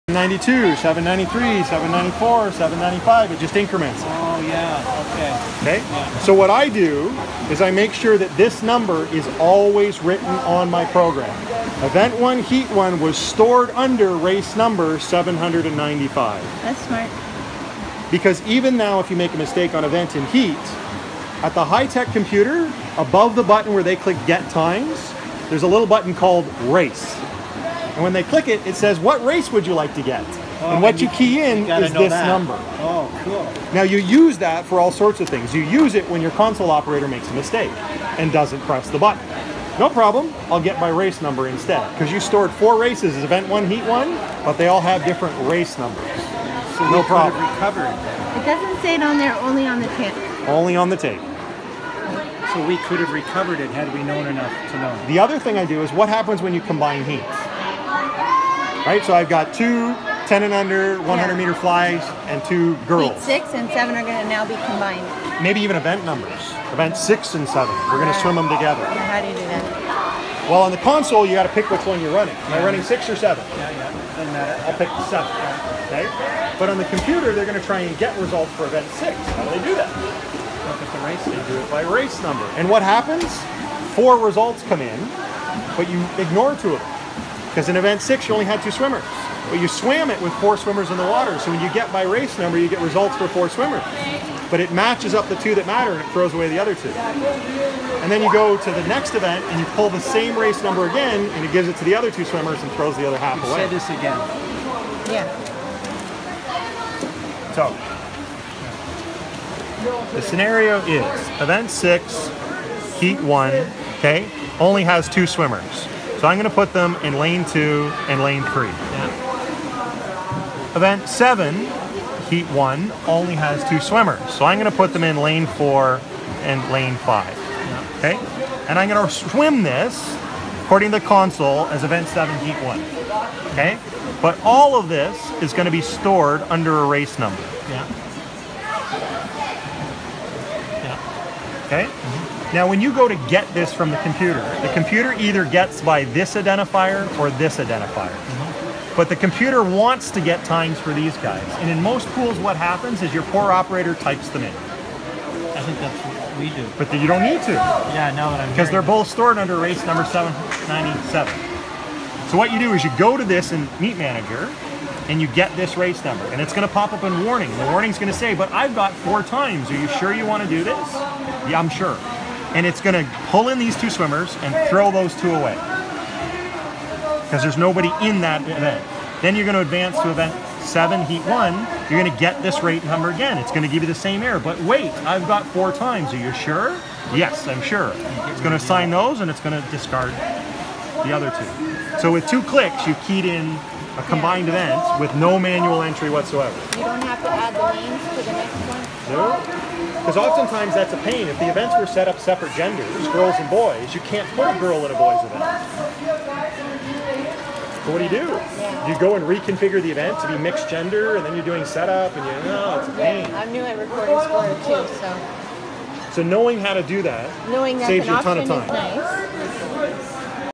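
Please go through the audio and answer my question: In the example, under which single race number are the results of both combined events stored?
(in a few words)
797.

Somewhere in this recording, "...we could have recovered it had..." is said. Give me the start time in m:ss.
0:52.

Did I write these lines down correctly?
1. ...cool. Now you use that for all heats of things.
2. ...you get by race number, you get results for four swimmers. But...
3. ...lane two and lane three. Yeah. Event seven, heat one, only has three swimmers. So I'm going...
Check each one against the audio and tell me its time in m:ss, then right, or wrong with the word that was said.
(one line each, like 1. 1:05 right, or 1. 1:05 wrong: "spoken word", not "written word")
1. 0:33 wrong: "sorts", not "heats"
2. 1:31 right
3. 1:57 wrong: "two", not "three".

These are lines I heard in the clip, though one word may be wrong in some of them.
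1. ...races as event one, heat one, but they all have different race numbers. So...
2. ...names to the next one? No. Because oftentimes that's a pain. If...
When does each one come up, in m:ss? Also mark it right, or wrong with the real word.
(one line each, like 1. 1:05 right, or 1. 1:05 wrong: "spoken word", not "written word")
1. 0:42 right
2. 3:17 right.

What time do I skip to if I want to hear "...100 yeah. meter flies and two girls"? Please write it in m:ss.
1:01.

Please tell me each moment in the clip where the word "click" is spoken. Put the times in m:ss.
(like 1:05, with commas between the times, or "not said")
0:23, 0:28, 3:12.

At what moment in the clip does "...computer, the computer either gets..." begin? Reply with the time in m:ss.
2:23.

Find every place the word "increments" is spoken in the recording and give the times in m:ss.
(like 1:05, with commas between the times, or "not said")
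0:03.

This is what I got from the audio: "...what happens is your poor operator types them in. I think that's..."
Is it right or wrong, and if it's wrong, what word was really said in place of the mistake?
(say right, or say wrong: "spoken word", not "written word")
right.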